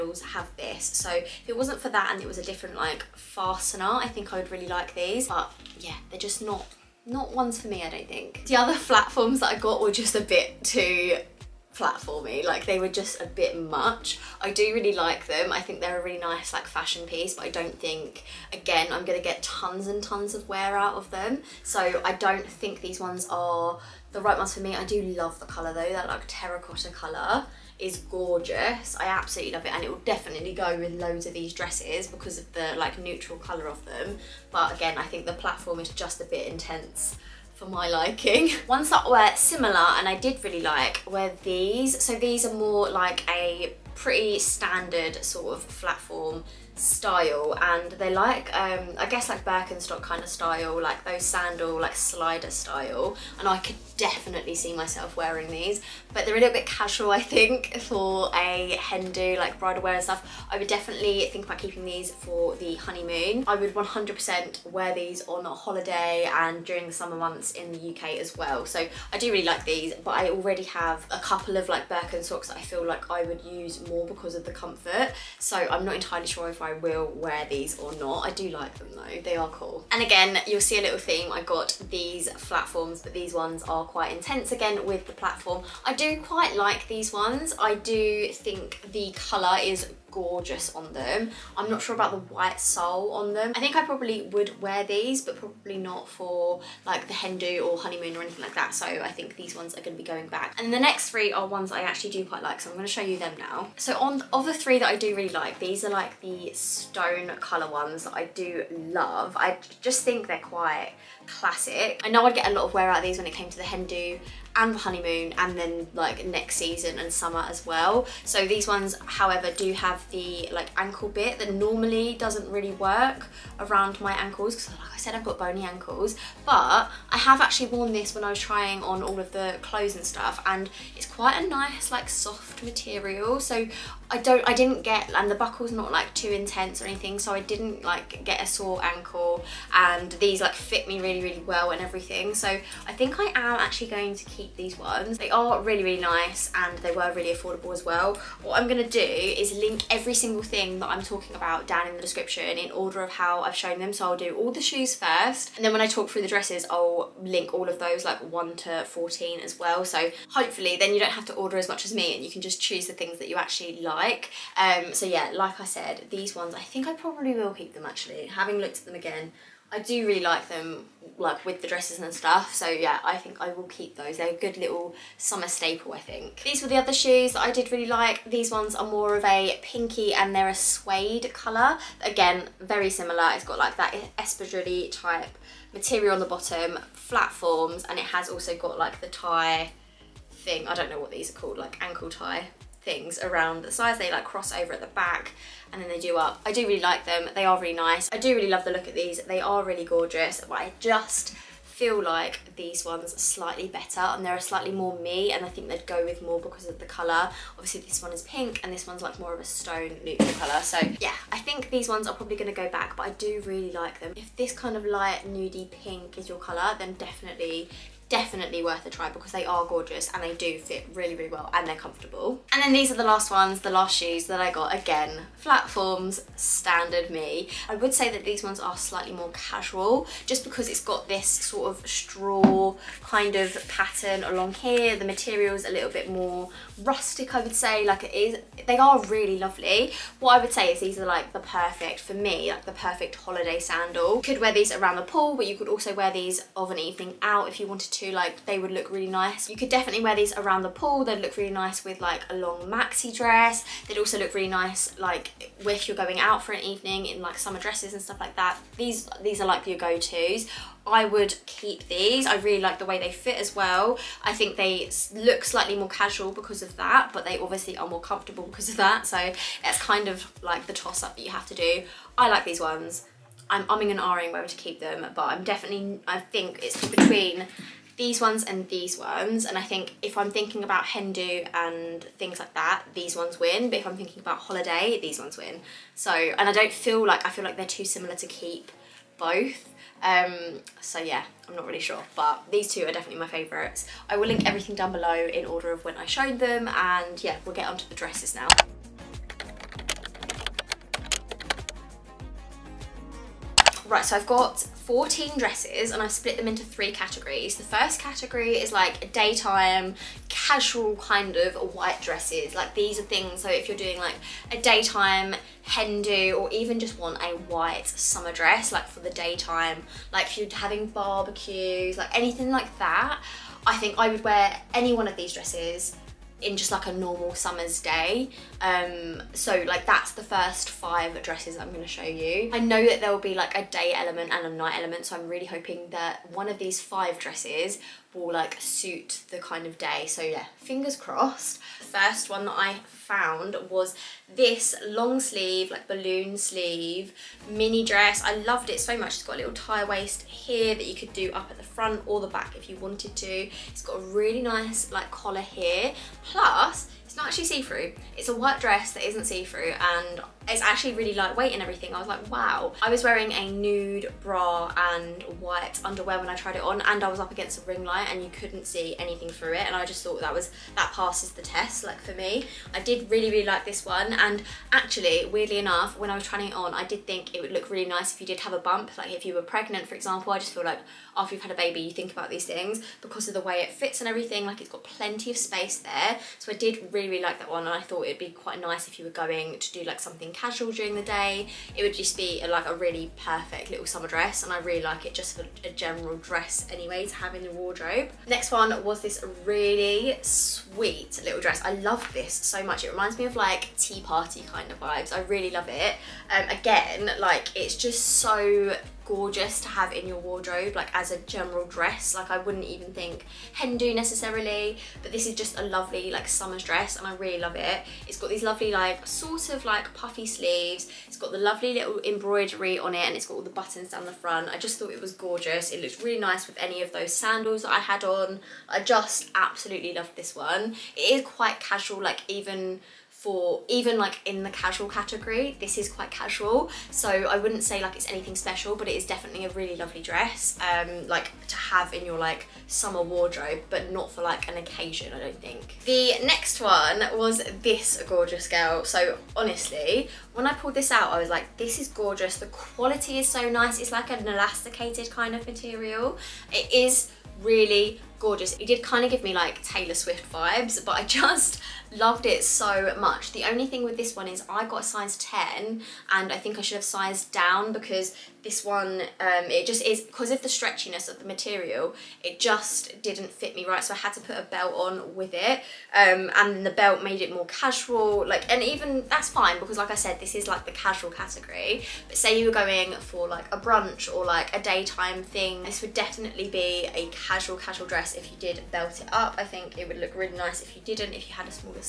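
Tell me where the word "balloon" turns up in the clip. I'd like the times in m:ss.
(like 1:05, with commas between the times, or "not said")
5:45.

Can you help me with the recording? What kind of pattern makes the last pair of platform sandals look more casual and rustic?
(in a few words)
Straw.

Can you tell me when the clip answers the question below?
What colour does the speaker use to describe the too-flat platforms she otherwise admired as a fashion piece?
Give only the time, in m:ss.
0:26.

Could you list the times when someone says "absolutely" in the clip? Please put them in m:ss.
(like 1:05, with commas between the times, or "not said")
0:29, 7:09.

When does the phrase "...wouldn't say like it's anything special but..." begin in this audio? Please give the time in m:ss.
7:17.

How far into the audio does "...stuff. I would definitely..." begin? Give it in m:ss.
1:00.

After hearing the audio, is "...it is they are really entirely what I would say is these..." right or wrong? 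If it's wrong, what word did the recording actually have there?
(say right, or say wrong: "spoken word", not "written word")
wrong: "lovely", not "entirely".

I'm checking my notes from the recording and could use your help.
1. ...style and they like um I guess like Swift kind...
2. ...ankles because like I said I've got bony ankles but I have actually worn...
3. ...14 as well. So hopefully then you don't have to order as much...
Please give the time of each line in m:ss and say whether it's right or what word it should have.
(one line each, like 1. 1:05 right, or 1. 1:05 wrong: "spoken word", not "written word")
1. 0:46 wrong: "Birkenstock", not "Swift"
2. 2:04 right
3. 2:38 right.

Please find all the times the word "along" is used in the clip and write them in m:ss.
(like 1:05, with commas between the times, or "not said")
3:54.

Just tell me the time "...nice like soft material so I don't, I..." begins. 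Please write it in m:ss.
2:11.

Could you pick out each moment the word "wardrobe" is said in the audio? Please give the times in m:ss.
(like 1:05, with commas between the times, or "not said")
6:37, 6:50, 7:23.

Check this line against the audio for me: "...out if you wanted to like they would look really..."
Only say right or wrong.
right.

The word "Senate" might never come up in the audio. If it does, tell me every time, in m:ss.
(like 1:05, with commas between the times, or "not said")
not said.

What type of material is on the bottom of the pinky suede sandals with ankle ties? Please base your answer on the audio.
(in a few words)
Espadrille.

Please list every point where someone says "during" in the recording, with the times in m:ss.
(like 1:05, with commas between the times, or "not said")
1:06, 6:30.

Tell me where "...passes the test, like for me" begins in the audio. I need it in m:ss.
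6:10.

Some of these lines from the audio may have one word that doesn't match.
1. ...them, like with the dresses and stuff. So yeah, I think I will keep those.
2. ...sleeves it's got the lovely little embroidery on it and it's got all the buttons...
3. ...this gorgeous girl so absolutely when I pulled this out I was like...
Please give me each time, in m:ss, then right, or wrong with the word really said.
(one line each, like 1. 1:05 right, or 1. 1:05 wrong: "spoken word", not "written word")
1. 2:50 right
2. 7:00 right
3. 7:27 wrong: "honestly", not "absolutely".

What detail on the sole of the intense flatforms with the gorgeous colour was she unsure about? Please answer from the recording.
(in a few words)
White sole.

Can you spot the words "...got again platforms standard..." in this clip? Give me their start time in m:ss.
3:44.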